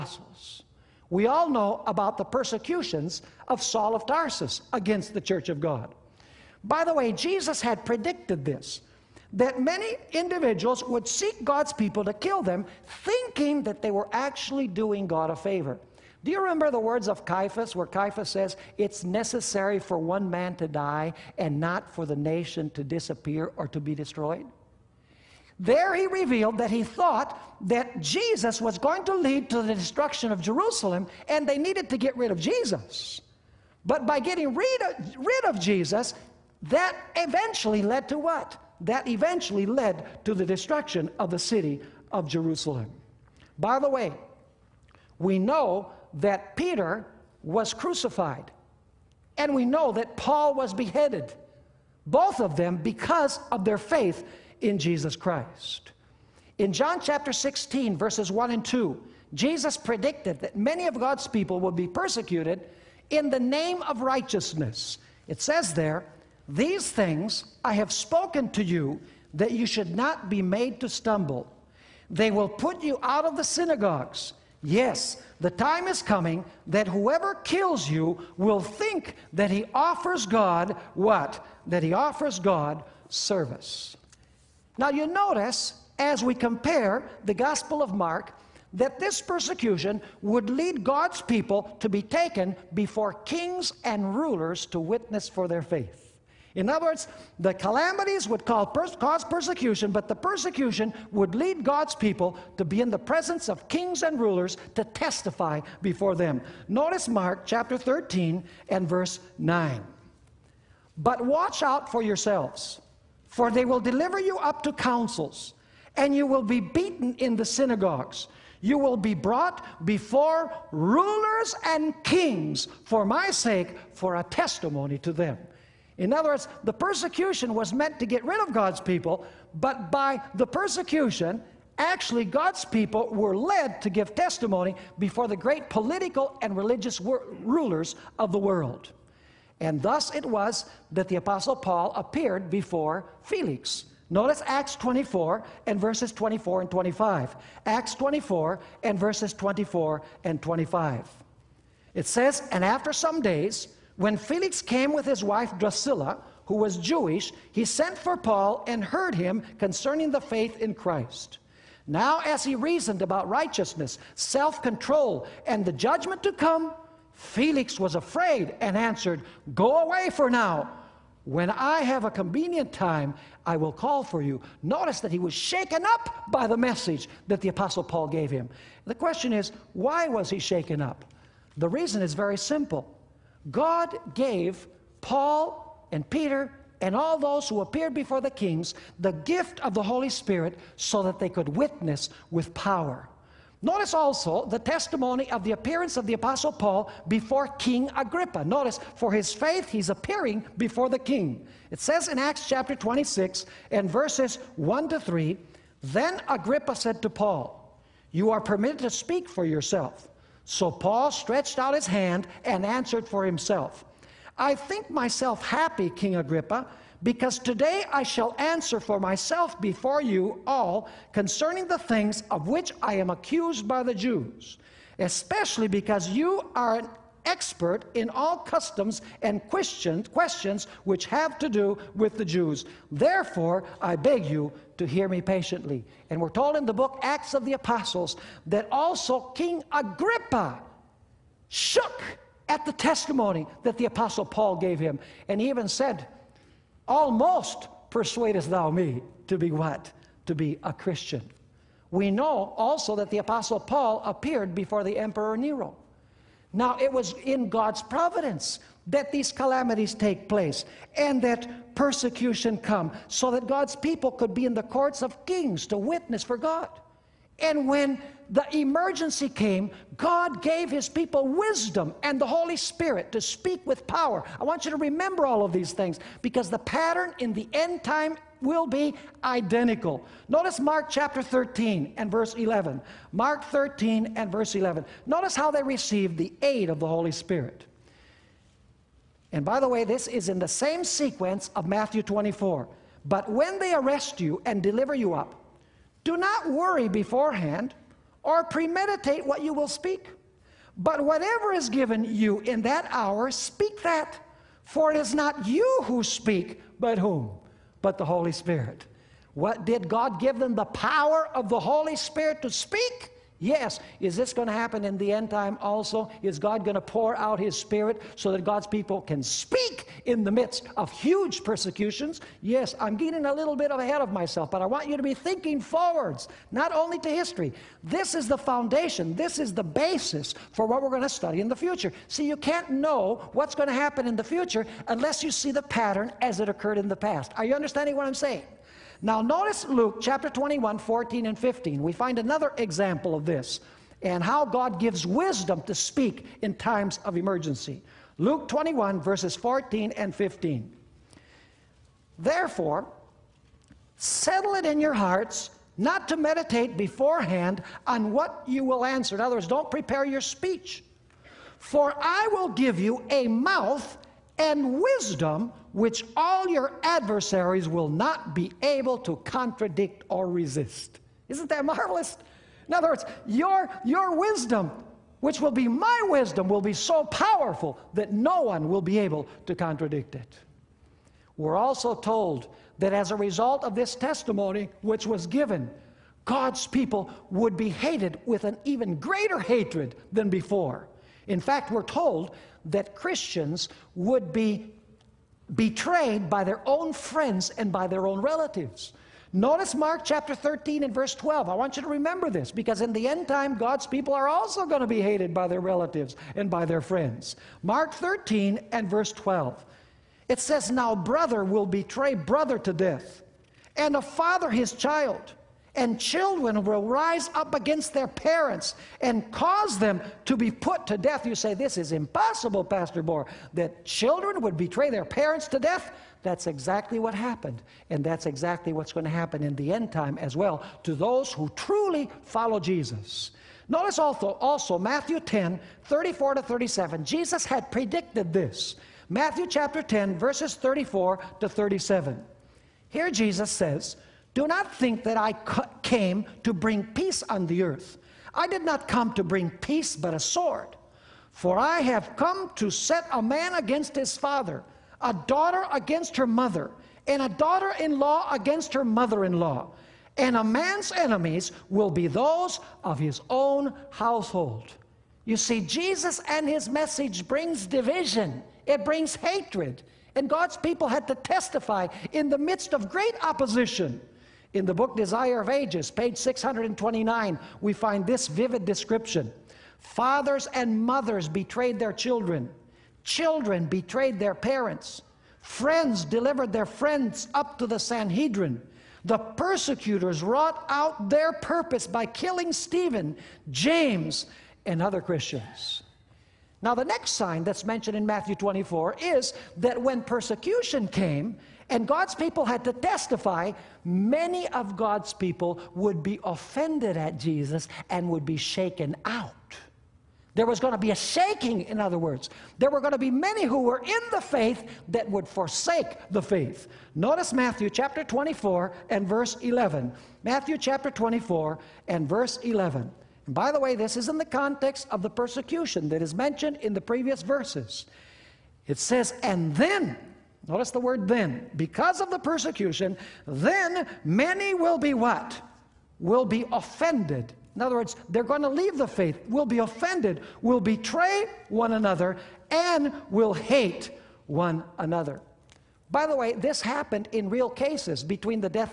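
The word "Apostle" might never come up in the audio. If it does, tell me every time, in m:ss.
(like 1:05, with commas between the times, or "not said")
2:21, 2:57, 3:16, 3:57, 4:03, 4:13.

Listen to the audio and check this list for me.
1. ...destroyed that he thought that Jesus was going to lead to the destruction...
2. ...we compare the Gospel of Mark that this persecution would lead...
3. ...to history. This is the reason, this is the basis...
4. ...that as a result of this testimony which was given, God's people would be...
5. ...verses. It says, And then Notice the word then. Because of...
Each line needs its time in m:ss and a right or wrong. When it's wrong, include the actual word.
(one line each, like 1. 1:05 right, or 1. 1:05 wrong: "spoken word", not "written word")
1. 0:26 wrong: "revealed", not "destroyed"
2. 1:26 right
3. 5:26 wrong: "foundation", not "reason"
4. 6:22 right
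5. 8:47 right.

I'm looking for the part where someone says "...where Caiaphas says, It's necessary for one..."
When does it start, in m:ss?
0:17.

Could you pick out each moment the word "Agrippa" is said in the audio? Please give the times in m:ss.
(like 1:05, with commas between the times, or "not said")
3:17, 3:26, 3:36, 3:59.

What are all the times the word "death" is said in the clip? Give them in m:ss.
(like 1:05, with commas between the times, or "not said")
6:52, 7:00, 7:05.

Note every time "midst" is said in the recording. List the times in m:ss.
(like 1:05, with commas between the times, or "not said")
5:20, 7:52.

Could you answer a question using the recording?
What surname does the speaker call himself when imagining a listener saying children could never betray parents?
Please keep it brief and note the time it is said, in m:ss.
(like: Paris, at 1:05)
Bohr, at 7:03.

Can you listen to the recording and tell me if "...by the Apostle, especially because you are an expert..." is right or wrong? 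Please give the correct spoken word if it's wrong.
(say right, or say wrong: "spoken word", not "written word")
wrong: "Jews", not "Apostle".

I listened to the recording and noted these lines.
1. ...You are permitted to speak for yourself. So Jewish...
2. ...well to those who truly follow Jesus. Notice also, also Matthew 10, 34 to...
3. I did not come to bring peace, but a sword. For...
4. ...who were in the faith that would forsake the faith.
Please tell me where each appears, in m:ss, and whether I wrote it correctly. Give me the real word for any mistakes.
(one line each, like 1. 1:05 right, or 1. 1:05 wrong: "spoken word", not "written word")
1. 3:28 wrong: "Paul", not "Jewish"
2. 7:10 right
3. 7:28 right
4. 8:33 right.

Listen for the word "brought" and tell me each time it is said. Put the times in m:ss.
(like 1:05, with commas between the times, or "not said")
1:59.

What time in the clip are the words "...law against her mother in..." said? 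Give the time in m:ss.
7:37.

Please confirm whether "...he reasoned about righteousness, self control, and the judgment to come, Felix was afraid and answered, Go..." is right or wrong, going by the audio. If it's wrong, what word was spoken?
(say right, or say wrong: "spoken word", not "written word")
right.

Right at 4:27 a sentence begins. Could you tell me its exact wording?
And when the emergency came, God gave his people wisdom and the Holy Spirit to speak with power.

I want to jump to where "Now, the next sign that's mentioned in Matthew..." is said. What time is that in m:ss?
8:16.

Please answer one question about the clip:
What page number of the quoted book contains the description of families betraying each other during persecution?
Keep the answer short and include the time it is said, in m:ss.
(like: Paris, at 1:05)
629, at 7:56.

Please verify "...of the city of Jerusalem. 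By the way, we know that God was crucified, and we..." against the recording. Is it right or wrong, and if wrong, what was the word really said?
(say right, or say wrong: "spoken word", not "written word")
wrong: "Peter", not "God".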